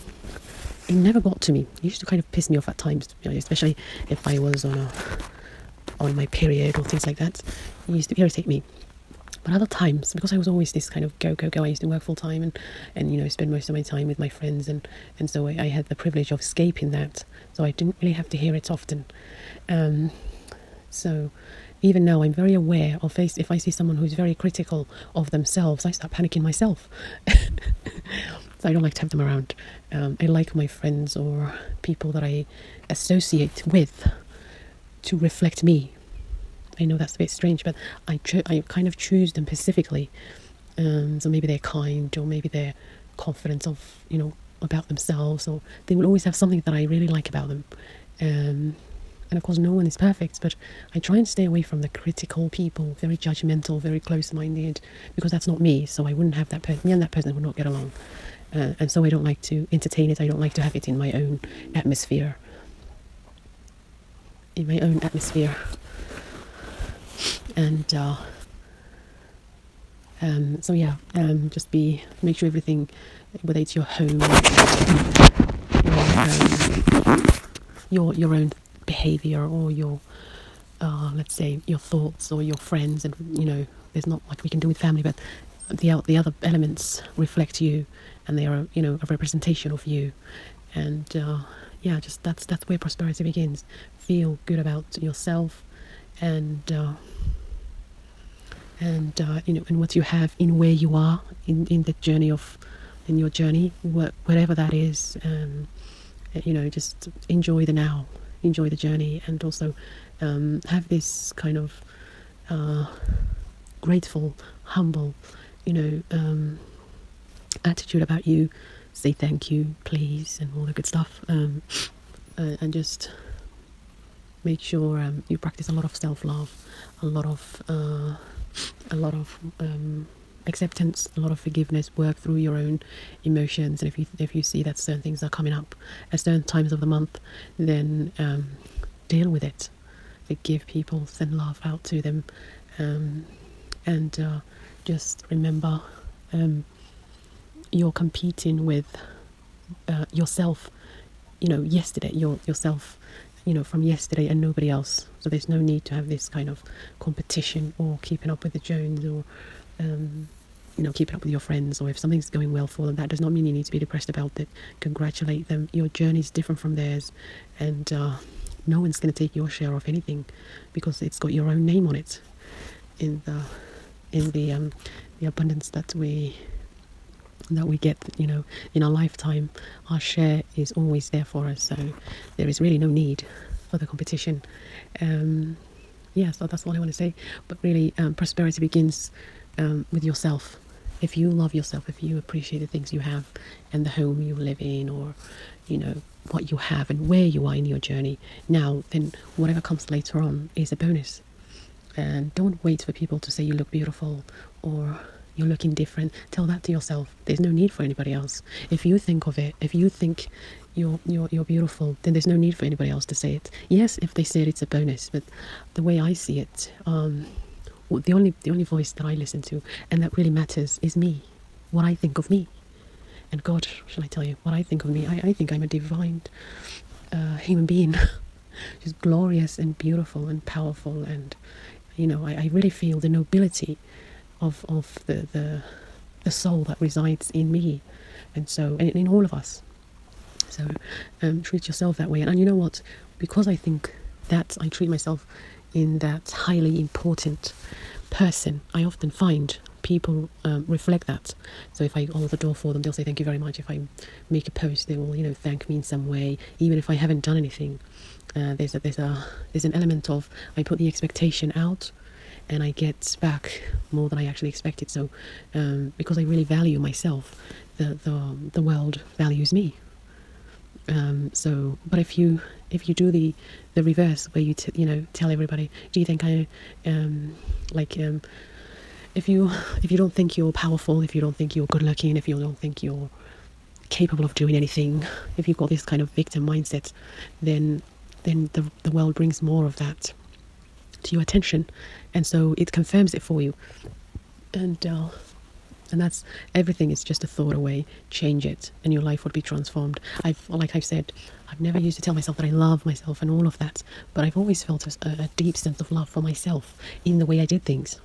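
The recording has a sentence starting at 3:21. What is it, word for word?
And don't wait for people to say you look beautiful or you're looking different.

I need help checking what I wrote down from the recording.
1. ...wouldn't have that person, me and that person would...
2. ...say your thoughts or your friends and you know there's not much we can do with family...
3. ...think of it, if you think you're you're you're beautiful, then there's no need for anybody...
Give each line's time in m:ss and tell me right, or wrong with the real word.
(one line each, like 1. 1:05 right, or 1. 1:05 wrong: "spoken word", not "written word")
1. 0:56 right
2. 1:21 right
3. 3:28 right.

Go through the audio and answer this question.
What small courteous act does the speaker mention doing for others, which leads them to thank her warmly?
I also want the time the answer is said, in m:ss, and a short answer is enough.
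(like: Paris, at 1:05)
hold the door, at 4:12.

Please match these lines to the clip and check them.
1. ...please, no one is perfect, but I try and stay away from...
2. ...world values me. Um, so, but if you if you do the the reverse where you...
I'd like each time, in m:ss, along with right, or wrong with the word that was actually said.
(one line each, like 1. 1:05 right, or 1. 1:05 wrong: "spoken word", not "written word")
1. 0:49 wrong: "course", not "please"
2. 4:28 right.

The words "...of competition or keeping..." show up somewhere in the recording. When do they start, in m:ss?
2:36.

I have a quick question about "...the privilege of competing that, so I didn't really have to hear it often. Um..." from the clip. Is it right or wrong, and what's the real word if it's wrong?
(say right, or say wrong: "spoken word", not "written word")
wrong: "escaping", not "competing".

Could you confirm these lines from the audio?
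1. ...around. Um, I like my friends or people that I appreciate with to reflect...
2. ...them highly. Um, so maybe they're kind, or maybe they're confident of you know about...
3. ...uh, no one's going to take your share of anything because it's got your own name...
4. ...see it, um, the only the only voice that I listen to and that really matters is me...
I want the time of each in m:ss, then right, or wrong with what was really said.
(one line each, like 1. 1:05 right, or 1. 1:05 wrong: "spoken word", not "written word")
1. 0:29 wrong: "associate", not "appreciate"
2. 0:39 wrong: "specifically", not "highly"
3. 2:47 right
4. 3:36 right.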